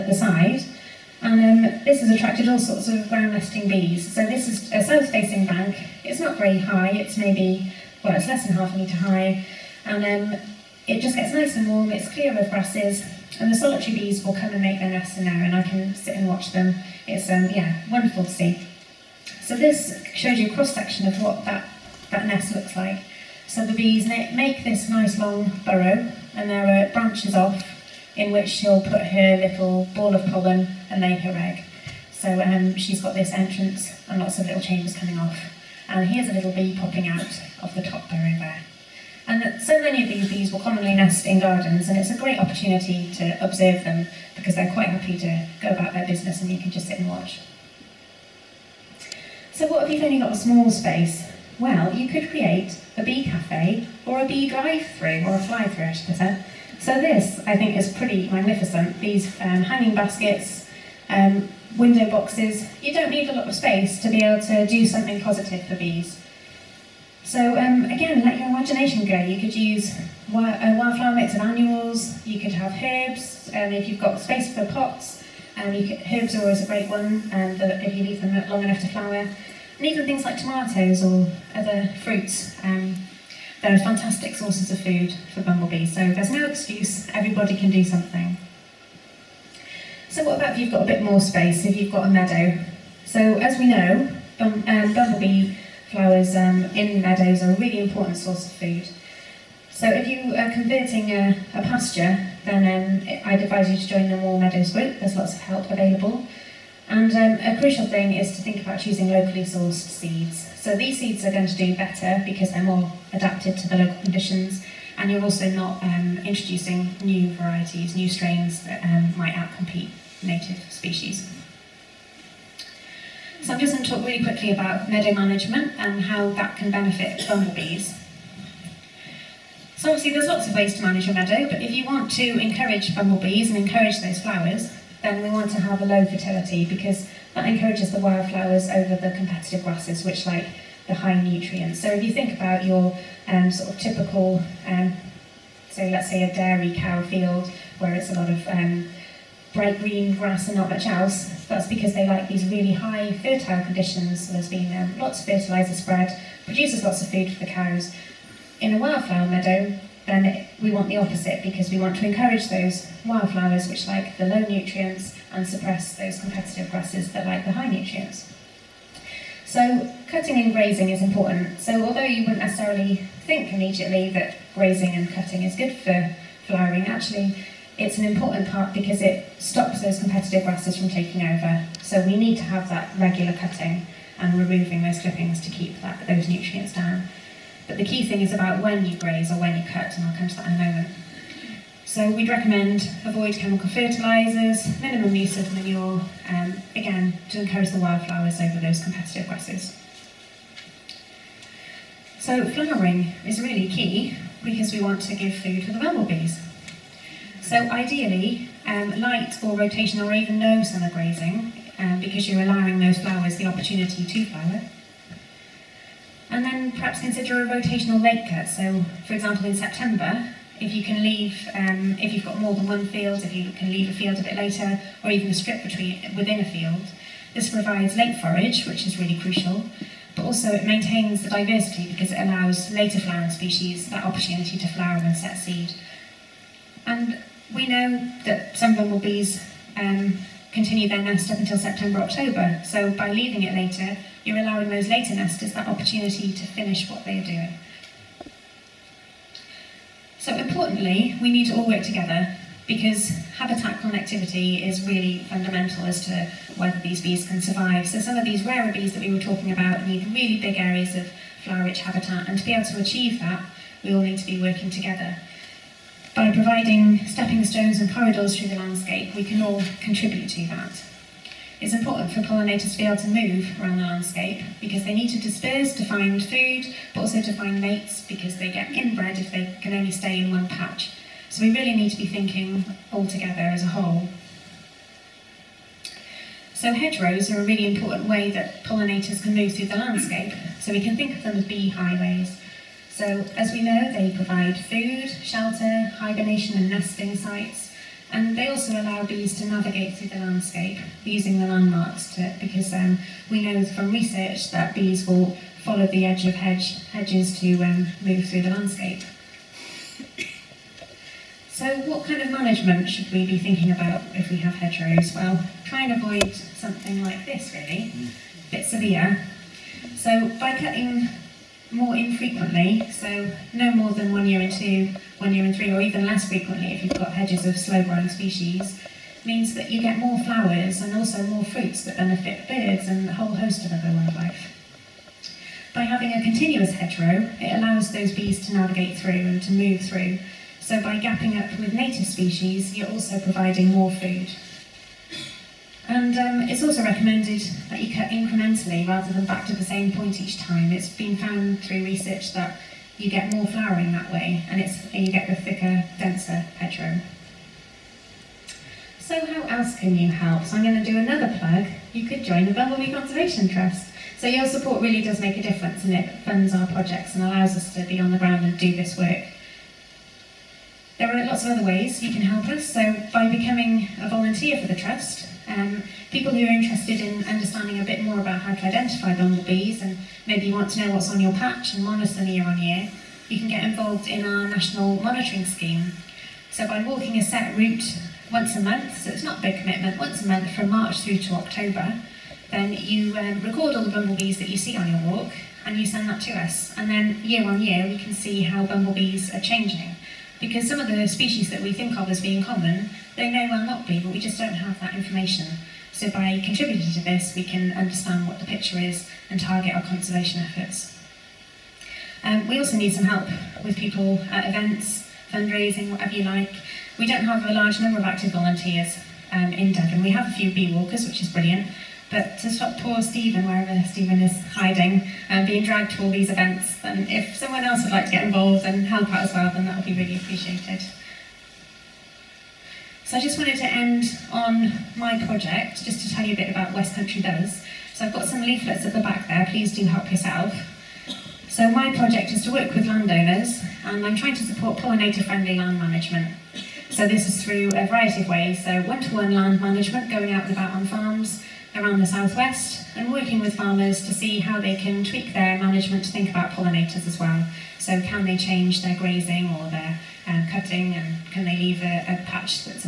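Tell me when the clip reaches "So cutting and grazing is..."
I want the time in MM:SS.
02:49.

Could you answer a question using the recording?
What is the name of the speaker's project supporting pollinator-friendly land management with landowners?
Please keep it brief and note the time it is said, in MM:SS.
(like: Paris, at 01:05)
West Country Buzz, at 07:16.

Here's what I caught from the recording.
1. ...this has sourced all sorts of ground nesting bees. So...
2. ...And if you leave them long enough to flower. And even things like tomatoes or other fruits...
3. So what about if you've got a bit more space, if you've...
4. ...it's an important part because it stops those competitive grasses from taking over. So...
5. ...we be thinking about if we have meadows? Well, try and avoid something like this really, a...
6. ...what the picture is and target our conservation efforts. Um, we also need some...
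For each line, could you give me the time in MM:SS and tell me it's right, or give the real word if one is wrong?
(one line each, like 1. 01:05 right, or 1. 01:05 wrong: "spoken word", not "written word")
1. 00:01 wrong: "attracted", not "sourced"
2. 01:17 right
3. 01:30 right
4. 02:57 right
5. 05:13 wrong: "hedgerows", not "meadows"
6. 06:48 right.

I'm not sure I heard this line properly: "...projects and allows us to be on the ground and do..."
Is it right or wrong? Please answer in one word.
right.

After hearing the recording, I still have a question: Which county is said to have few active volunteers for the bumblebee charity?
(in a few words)
Devon.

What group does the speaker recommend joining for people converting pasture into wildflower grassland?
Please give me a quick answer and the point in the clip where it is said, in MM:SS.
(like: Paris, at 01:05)
Moor Meadows, at 01:44.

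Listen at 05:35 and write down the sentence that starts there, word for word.
By having a continuous hedgerow, it allows those bees to navigate through and to move through.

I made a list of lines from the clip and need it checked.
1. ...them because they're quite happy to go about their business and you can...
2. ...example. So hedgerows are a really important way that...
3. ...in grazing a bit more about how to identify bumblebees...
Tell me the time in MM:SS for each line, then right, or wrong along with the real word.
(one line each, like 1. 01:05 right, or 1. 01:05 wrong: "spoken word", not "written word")
1. 00:43 right
2. 04:43 wrong: "whole", not "example"
3. 06:16 wrong: "understanding", not "grazing".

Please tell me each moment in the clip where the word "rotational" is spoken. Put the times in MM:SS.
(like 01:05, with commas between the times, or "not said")
03:29, 03:37.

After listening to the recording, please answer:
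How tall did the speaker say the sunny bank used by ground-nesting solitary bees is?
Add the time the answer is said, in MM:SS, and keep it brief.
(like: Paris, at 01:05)
less than half a metre, at 00:08.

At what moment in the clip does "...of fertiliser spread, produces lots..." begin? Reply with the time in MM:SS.
02:35.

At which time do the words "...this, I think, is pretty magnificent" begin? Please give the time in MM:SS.
00:57.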